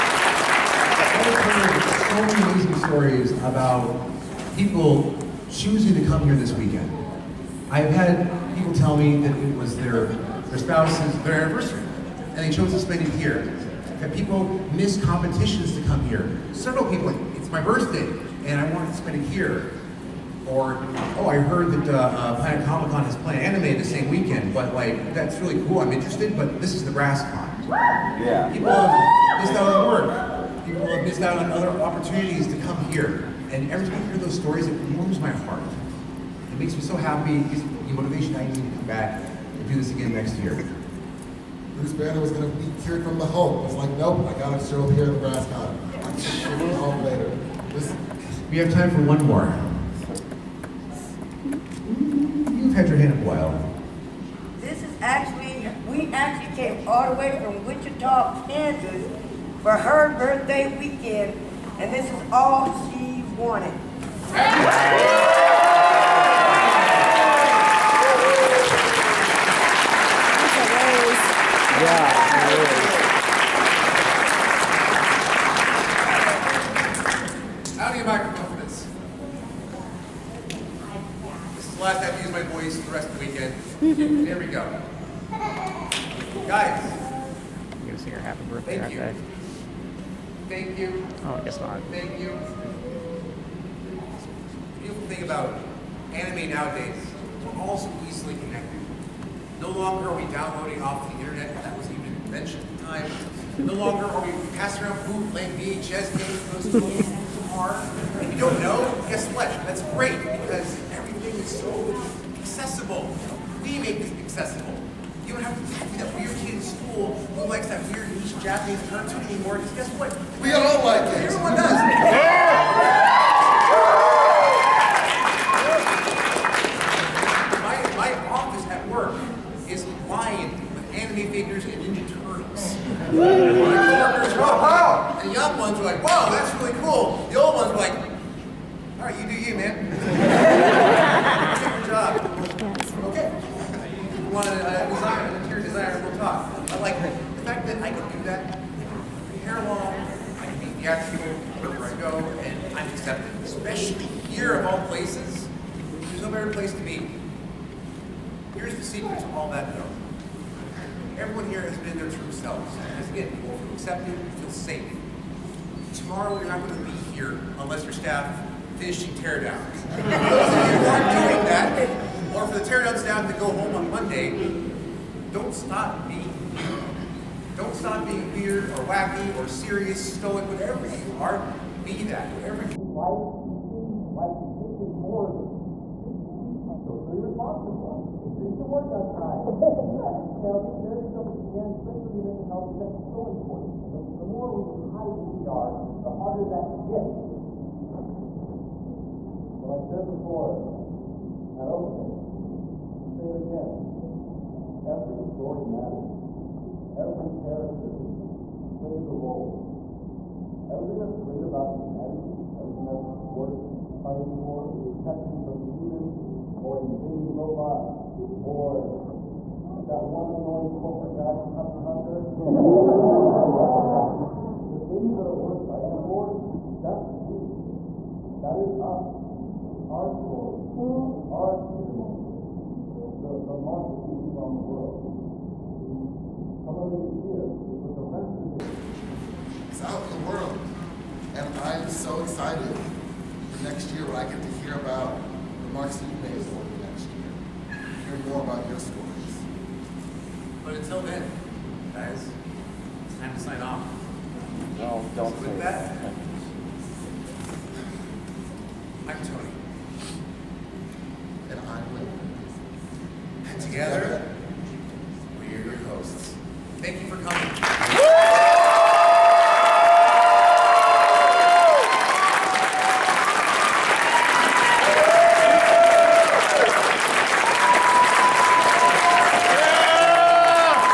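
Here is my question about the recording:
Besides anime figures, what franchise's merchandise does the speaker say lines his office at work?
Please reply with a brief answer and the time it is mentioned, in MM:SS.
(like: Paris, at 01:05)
Ninja Turtles, at 02:11.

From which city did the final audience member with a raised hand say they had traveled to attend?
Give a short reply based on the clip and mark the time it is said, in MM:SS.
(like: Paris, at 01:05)
Wichita, Kansas, at 00:57.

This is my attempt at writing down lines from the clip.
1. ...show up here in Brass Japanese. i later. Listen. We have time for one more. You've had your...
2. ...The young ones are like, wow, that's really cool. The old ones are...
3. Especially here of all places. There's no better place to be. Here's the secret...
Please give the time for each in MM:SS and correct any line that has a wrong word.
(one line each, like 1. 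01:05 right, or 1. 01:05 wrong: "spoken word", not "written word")
1. 00:44 wrong: "Con", not "Japanese"
2. 02:15 right
3. 02:33 right.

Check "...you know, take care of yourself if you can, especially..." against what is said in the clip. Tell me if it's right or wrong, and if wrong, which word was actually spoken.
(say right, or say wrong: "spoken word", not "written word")
right.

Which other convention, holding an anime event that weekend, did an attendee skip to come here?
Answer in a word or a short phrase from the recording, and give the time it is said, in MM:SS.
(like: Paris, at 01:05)
Planet Comic Con, at 00:22.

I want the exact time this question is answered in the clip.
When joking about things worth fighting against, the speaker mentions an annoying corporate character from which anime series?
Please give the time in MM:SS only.
03:41.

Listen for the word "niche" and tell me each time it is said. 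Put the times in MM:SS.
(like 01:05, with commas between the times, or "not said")
01:58.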